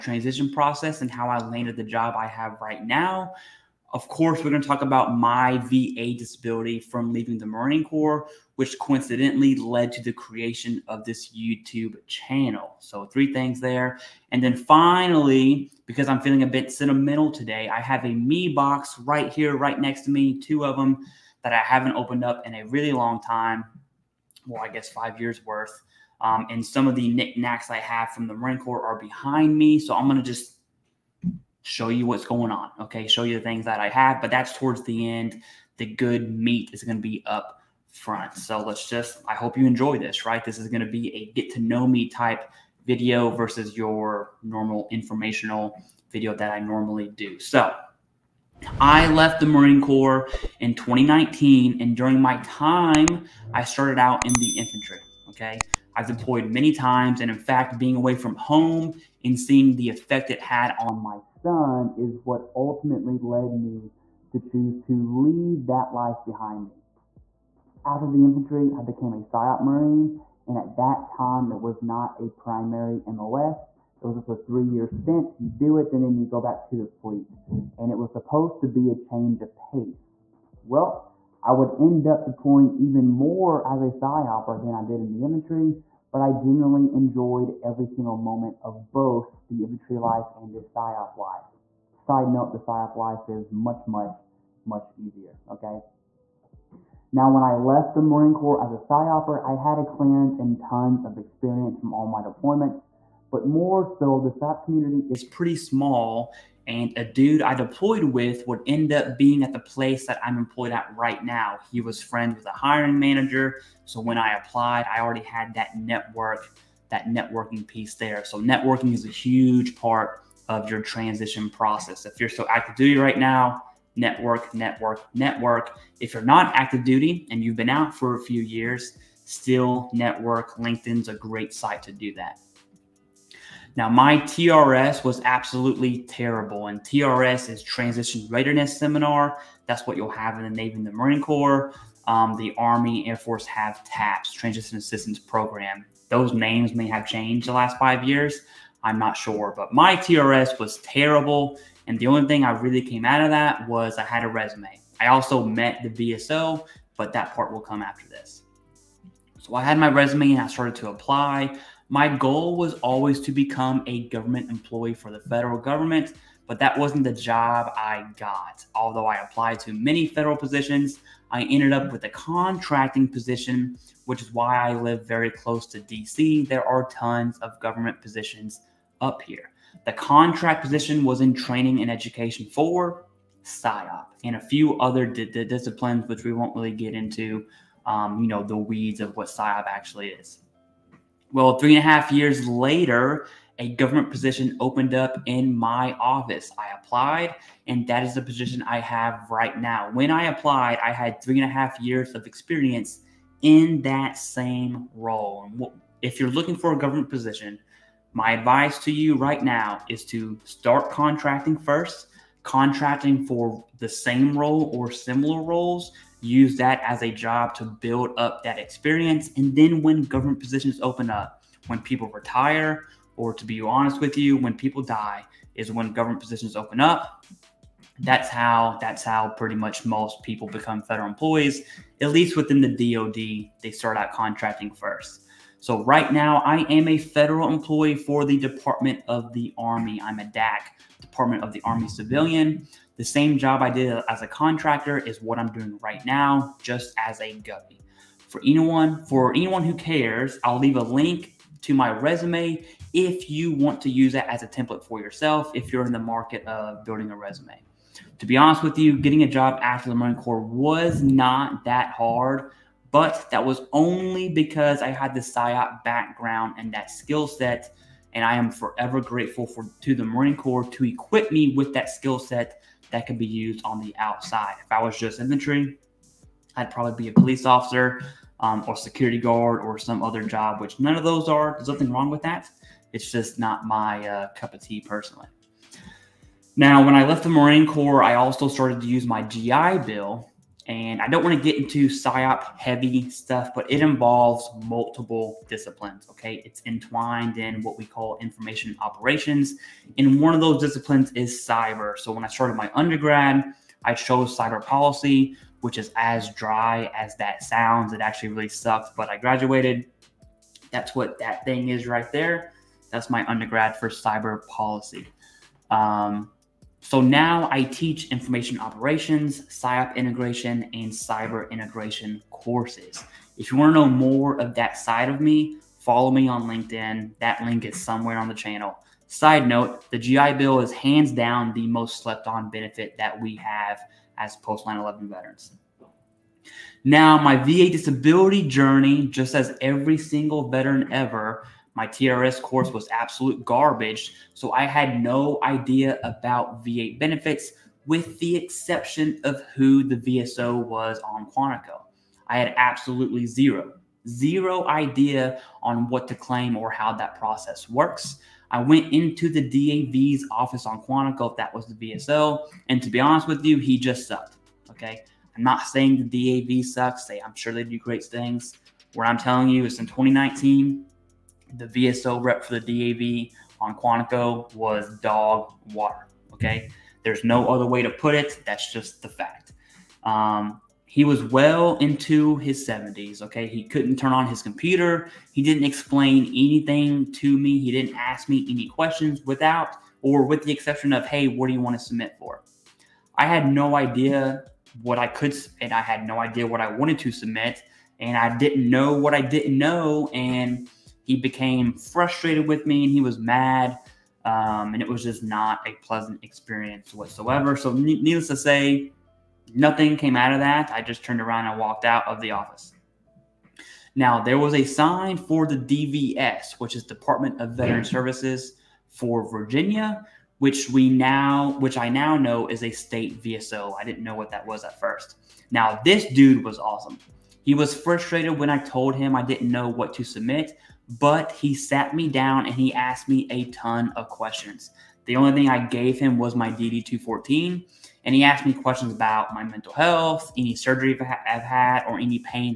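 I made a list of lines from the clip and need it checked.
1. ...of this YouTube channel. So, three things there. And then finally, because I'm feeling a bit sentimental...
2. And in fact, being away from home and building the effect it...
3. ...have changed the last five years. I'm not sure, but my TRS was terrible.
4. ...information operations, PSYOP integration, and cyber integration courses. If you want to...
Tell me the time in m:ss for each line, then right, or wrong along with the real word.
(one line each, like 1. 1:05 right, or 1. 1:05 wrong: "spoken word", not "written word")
1. 0:10 right
2. 0:57 wrong: "seeing", not "building"
3. 2:26 right
4. 5:18 right.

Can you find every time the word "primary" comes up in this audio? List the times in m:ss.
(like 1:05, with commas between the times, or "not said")
1:12.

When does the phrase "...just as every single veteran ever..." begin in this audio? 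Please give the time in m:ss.
5:39.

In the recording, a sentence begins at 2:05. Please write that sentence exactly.
If you're not active duty and you've been out for a few years, still network.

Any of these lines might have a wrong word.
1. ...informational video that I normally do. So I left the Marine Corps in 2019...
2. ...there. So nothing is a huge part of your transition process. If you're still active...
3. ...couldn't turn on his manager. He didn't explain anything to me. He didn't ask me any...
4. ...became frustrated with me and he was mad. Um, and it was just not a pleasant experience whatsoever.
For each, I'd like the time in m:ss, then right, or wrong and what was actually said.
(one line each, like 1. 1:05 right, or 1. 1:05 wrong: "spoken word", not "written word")
1. 0:44 right
2. 1:57 wrong: "networking", not "nothing"
3. 6:23 wrong: "computer", not "manager"
4. 6:41 right.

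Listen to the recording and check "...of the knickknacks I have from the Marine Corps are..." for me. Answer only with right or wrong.
right.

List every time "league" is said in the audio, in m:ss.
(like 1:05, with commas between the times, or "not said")
not said.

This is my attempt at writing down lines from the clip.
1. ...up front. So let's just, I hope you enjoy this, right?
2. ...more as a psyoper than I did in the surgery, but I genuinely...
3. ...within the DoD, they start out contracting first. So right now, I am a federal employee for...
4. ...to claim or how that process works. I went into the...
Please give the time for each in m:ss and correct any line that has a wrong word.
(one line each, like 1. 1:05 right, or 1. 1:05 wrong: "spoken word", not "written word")
1. 0:37 right
2. 1:23 wrong: "infantry", not "surgery"
3. 3:52 right
4. 5:56 right.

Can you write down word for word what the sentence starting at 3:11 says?
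Well, three and a half years later, a government position opened up in my office.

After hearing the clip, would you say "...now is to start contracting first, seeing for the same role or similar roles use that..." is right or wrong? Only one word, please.
wrong.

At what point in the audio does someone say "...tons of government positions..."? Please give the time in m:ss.
2:56.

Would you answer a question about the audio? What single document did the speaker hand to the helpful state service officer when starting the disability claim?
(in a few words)
DD214.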